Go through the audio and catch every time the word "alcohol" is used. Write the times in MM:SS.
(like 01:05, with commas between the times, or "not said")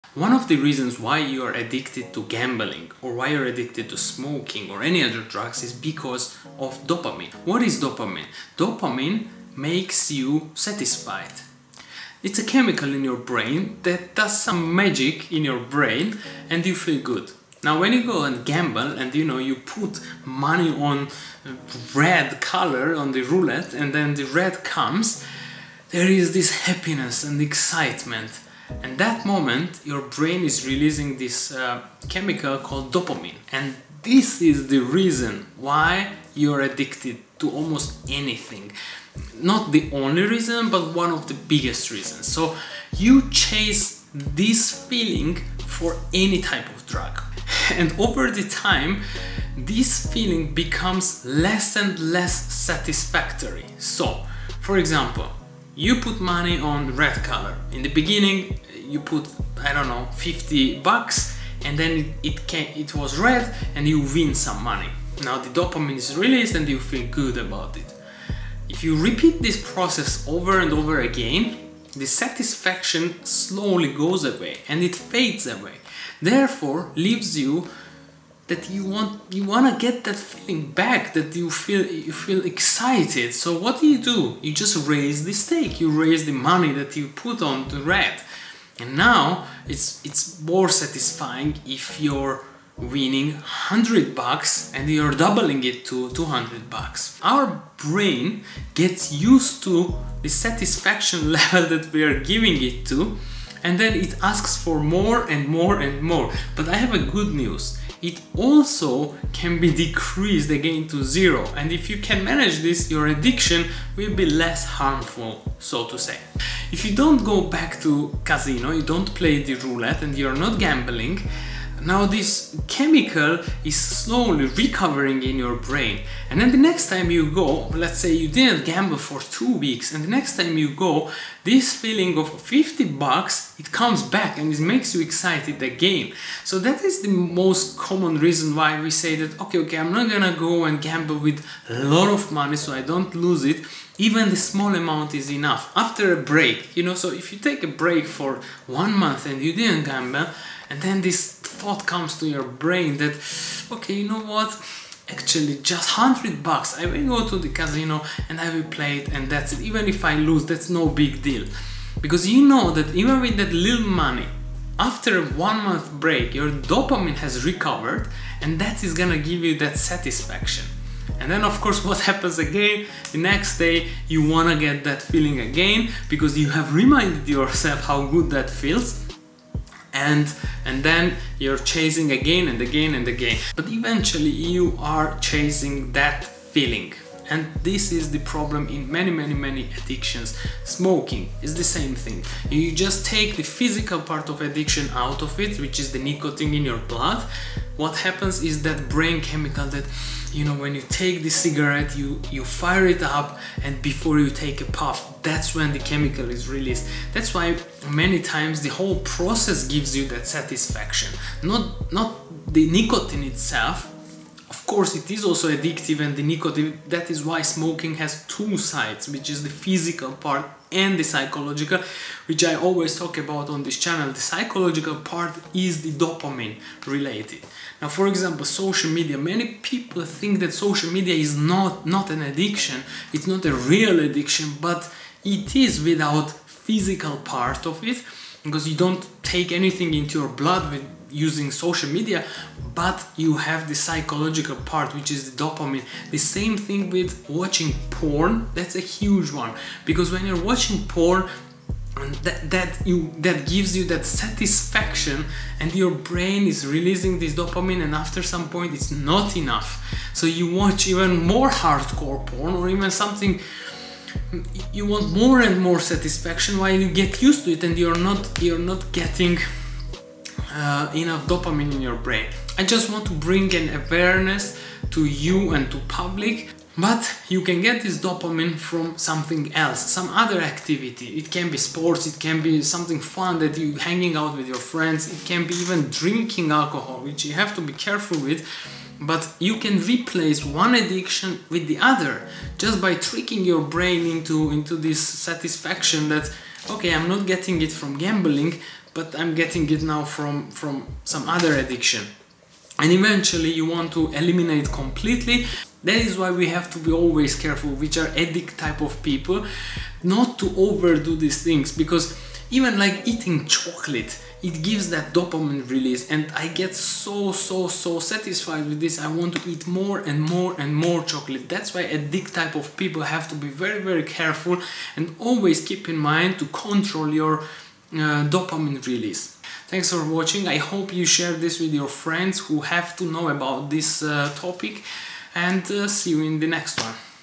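04:46.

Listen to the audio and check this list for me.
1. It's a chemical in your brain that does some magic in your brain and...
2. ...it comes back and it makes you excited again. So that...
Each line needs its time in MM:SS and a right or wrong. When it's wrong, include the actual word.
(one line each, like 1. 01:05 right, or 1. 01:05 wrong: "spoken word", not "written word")
1. 00:12 right
2. 02:13 right.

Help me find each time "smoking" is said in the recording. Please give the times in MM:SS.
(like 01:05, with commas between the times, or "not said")
00:03, 03:10, 03:37.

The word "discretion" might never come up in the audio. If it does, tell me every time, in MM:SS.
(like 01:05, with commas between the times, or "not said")
not said.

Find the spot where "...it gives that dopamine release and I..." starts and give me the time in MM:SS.
05:14.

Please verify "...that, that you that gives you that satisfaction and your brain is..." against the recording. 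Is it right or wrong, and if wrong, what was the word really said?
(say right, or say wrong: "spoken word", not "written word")
right.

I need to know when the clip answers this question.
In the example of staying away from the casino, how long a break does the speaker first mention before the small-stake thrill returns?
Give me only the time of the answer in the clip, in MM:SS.
02:09.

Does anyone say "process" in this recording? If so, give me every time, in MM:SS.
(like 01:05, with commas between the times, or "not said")
01:09, 03:29.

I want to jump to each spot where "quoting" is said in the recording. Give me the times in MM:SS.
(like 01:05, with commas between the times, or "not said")
not said.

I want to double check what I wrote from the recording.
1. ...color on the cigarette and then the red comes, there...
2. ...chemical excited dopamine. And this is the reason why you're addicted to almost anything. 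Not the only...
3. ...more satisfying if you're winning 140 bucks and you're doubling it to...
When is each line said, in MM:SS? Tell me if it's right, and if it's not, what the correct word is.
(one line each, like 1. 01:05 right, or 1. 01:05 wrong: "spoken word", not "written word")
1. 00:22 wrong: "roulette", not "cigarette"
2. 00:32 wrong: "called", not "excited"
3. 01:30 wrong: "100", not "140".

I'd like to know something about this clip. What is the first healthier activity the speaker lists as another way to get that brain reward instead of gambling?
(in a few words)
sports.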